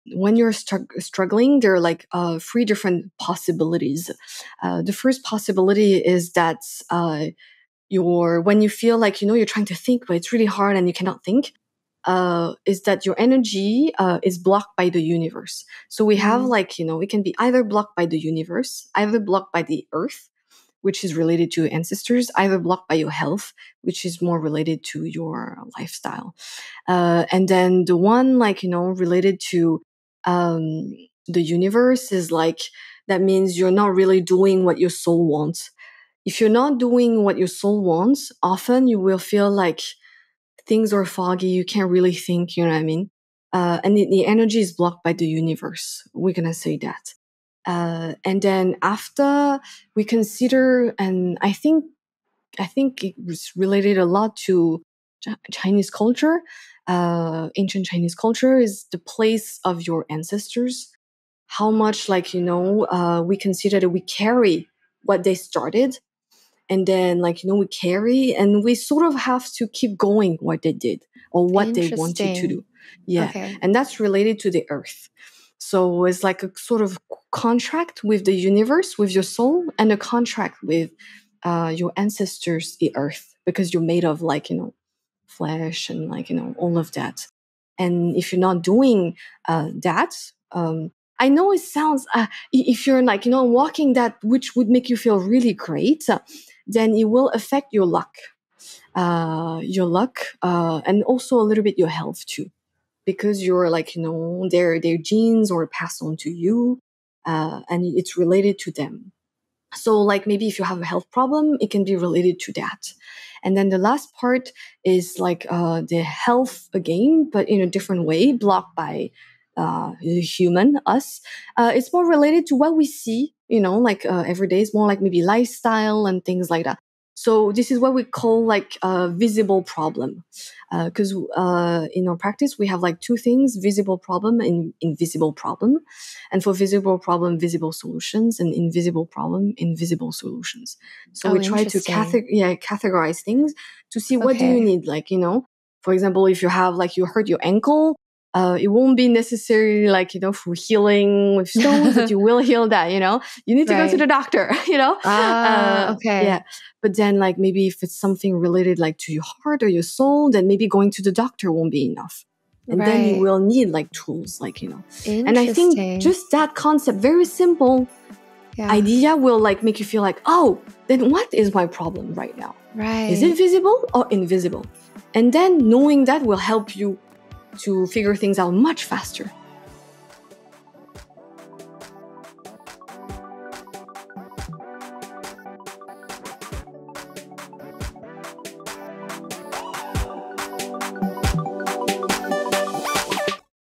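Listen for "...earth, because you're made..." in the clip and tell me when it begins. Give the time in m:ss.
1:22.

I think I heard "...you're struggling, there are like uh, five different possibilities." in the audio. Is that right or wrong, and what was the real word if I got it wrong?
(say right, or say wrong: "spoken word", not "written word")
wrong: "three", not "five".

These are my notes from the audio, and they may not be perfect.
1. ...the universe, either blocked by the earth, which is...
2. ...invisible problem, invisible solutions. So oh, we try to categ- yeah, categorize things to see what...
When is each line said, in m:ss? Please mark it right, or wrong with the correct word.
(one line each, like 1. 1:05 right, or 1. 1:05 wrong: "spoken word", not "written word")
1. 0:18 right
2. 2:18 right.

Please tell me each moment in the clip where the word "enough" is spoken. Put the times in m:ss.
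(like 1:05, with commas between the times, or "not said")
2:41.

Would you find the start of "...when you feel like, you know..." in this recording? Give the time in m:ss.
0:08.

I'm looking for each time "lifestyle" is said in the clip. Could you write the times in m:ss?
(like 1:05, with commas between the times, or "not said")
0:25, 2:05.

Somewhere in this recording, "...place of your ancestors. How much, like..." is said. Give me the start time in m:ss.
0:58.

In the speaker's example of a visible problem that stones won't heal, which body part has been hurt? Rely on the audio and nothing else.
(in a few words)
ankle.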